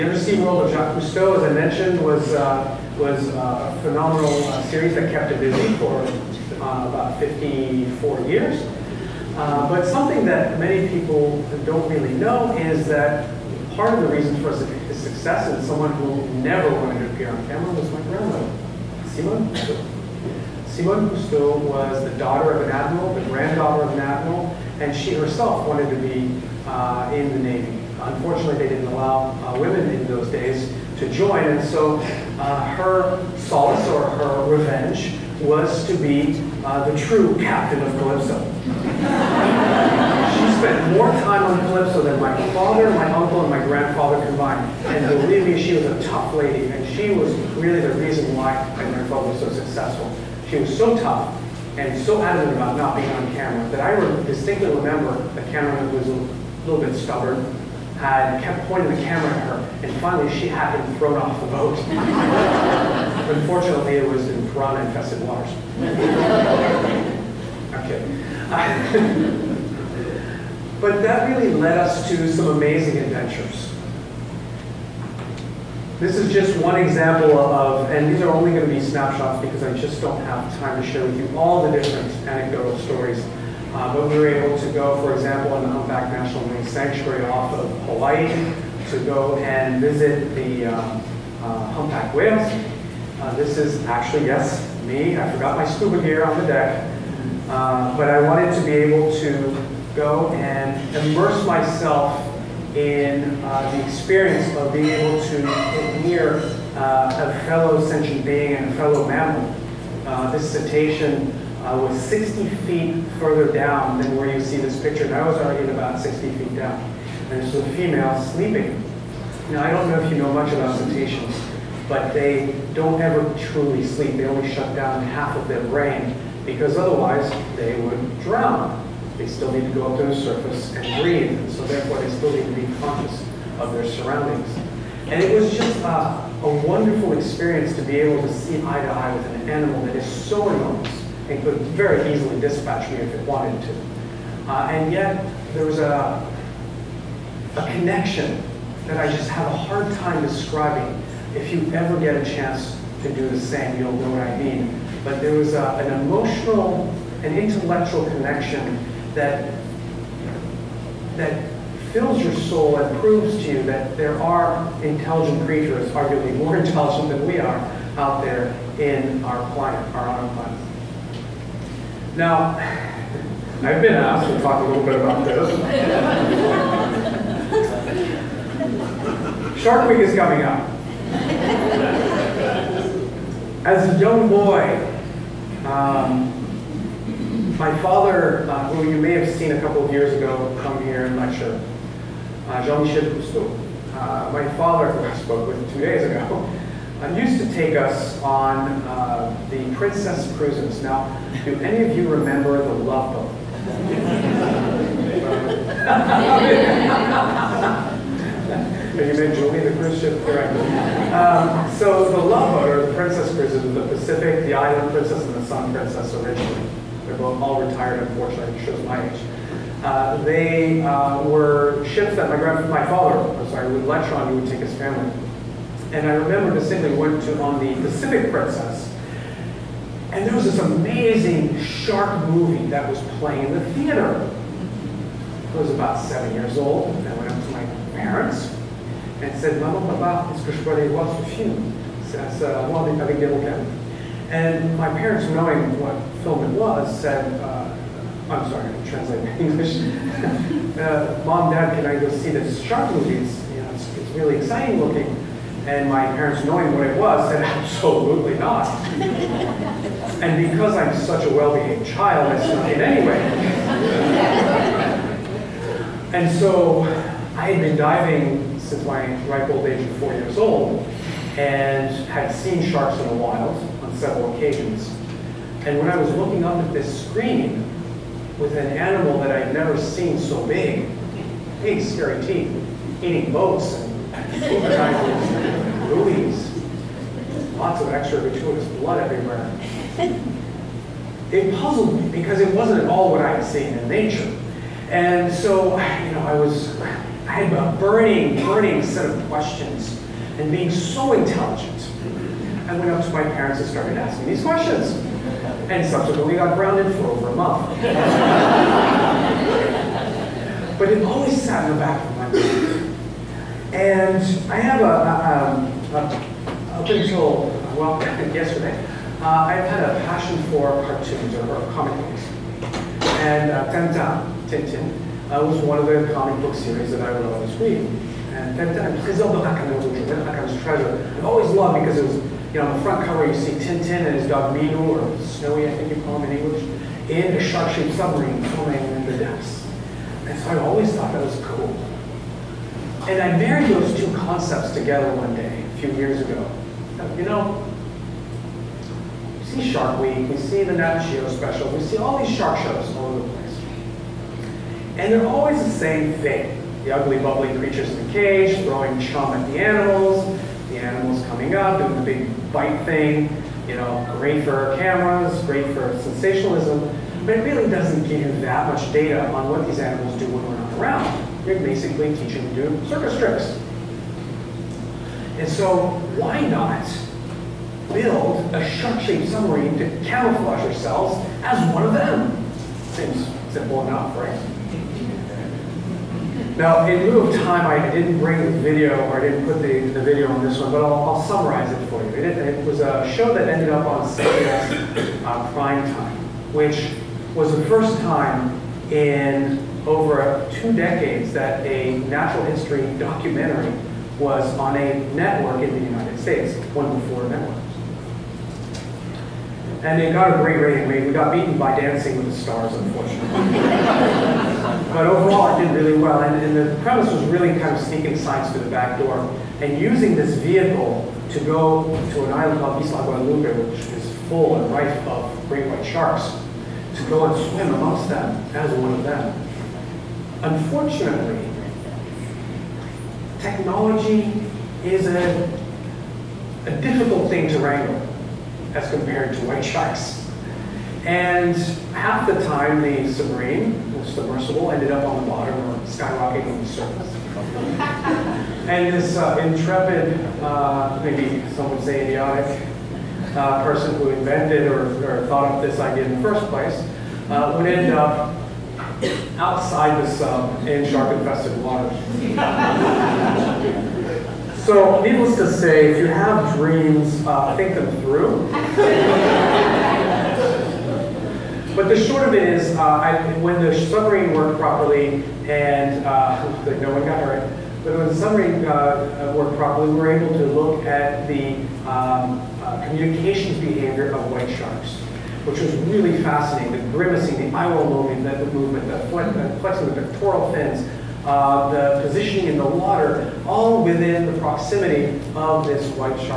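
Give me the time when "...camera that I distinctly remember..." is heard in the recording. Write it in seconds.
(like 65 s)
53 s.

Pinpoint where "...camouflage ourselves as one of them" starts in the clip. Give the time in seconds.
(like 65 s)
380 s.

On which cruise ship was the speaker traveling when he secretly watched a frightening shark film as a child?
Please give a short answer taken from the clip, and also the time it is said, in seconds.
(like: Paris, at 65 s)
Pacific Princess, at 227 s.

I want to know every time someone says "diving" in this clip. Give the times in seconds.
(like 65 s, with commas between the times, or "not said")
267 s.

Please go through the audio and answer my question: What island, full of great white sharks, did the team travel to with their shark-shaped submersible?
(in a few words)
Isla Guadalupe.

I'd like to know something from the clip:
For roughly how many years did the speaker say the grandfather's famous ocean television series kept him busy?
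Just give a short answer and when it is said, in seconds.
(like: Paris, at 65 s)
54 years, at 7 s.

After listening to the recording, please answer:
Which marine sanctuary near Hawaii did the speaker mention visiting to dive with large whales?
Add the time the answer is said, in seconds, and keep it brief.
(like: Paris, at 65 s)
Humpback National Marine Sanctuary, at 85 s.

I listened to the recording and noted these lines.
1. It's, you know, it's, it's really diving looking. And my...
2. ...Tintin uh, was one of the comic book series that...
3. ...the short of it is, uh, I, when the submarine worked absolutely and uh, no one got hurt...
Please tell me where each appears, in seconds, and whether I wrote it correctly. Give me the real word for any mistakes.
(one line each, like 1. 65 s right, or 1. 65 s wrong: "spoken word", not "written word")
1. 253 s wrong: "exciting", not "diving"
2. 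324 s right
3. 471 s wrong: "properly", not "absolutely".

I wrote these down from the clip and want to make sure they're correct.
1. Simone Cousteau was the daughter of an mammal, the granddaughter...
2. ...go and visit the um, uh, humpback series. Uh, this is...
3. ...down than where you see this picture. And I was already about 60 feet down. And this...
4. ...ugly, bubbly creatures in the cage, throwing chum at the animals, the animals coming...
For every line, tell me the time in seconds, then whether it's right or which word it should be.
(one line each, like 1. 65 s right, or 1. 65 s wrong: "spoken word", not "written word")
1. 20 s wrong: "admiral", not "mammal"
2. 89 s wrong: "whales", not "series"
3. 113 s right
4. 356 s right.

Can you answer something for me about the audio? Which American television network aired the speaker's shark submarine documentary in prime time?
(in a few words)
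CBS.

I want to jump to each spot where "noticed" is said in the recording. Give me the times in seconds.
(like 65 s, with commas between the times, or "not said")
not said.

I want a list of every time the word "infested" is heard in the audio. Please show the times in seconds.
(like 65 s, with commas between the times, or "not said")
64 s, 461 s.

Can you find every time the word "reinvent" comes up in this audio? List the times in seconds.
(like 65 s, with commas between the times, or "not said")
not said.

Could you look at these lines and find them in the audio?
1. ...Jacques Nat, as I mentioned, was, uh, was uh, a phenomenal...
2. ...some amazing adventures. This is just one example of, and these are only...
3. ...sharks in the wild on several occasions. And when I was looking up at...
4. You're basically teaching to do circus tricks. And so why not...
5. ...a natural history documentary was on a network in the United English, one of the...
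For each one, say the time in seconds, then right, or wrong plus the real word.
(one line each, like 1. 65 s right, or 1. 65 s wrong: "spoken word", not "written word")
1. 0 s wrong: "Cousteau", not "Nat"
2. 72 s right
3. 272 s right
4. 371 s right
5. 401 s wrong: "States", not "English".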